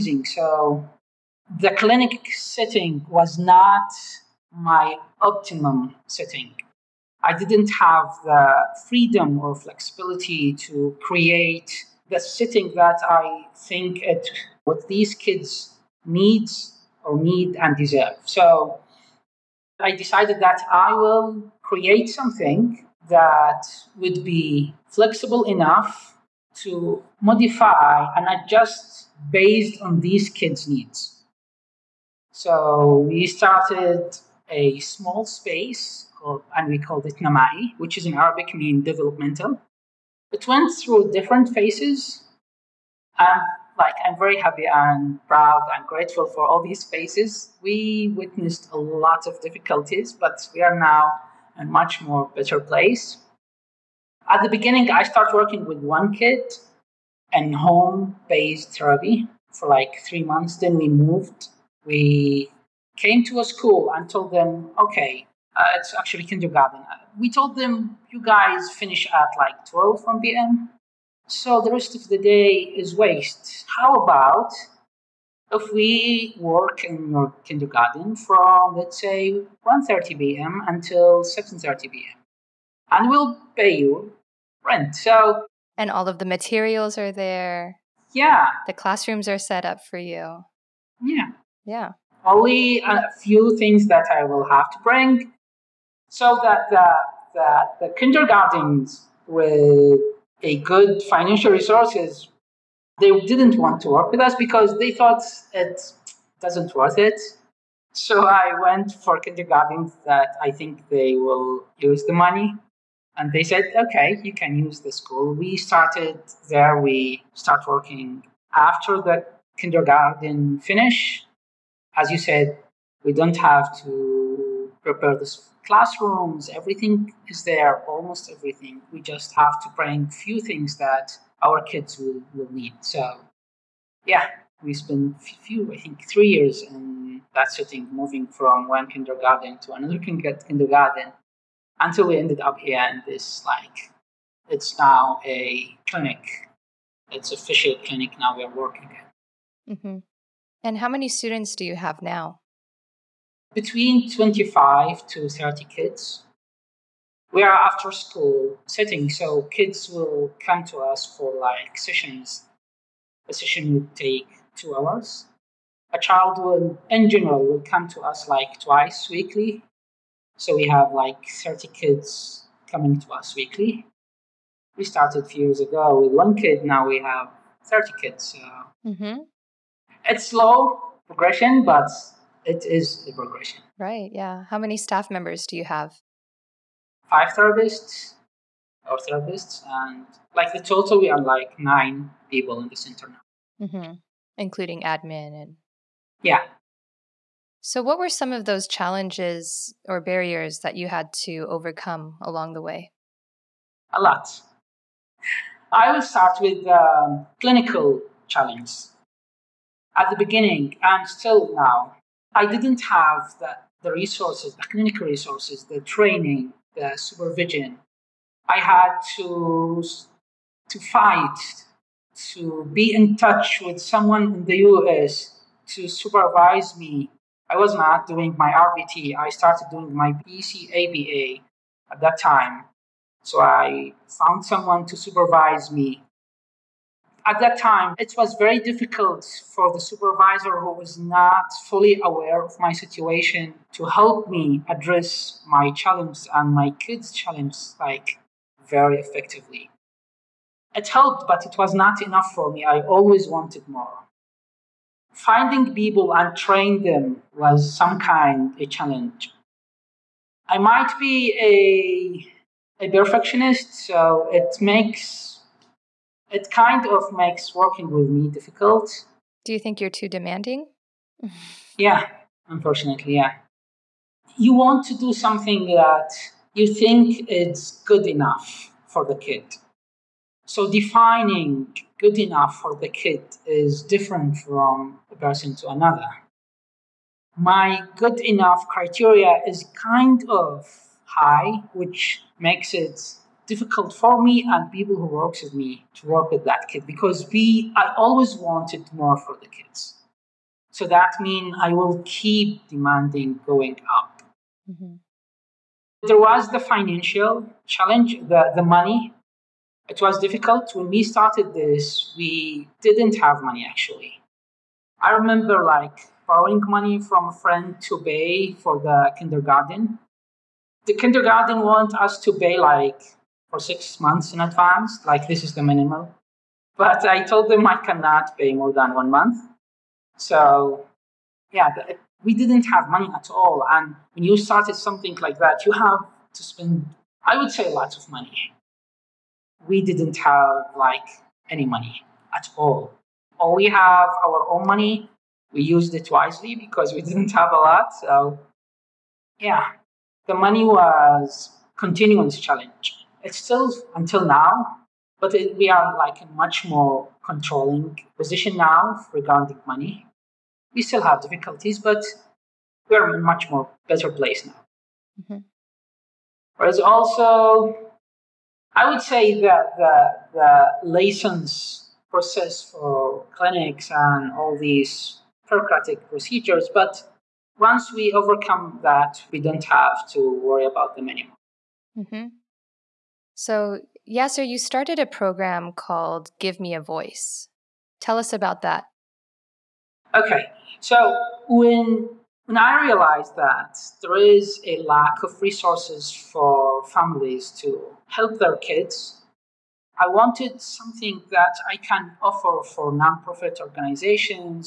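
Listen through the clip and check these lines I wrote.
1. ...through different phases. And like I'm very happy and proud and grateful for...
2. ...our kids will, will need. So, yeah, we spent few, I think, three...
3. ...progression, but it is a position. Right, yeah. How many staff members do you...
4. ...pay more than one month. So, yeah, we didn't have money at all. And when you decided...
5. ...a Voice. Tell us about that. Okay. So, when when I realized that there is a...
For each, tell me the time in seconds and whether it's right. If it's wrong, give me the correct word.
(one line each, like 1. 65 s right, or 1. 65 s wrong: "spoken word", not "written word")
1. 40 s right
2. 131 s right
3. 181 s wrong: "progression", not "position"
4. 328 s wrong: "started", not "decided"
5. 386 s right.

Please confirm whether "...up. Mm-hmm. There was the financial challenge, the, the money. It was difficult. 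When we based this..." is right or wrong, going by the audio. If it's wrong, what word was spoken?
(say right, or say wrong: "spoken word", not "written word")
wrong: "started", not "based".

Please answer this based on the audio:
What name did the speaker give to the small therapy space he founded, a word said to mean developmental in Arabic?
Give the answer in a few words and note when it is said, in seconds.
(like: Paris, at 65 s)
Namaee, at 37 s.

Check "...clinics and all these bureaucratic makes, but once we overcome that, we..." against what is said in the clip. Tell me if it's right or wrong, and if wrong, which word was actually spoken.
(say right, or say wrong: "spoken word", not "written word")
wrong: "procedures", not "makes".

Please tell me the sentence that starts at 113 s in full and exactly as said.
And they said, okay, you can use the school.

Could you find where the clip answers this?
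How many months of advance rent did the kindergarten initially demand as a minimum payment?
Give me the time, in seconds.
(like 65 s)
323 s.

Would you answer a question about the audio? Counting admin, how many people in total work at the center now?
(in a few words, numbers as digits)
9.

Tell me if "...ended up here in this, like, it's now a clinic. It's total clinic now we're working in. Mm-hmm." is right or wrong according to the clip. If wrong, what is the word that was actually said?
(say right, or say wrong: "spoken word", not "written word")
wrong: "official", not "total".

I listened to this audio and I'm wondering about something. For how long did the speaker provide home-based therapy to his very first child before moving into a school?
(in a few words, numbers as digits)
3 months.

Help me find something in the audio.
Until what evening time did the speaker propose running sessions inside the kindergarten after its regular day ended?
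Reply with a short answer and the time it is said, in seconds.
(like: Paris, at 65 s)
7:30 p.m., at 81 s.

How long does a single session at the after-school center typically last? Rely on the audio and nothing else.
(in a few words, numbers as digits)
2 hours.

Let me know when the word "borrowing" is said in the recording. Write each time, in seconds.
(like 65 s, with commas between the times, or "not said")
316 s.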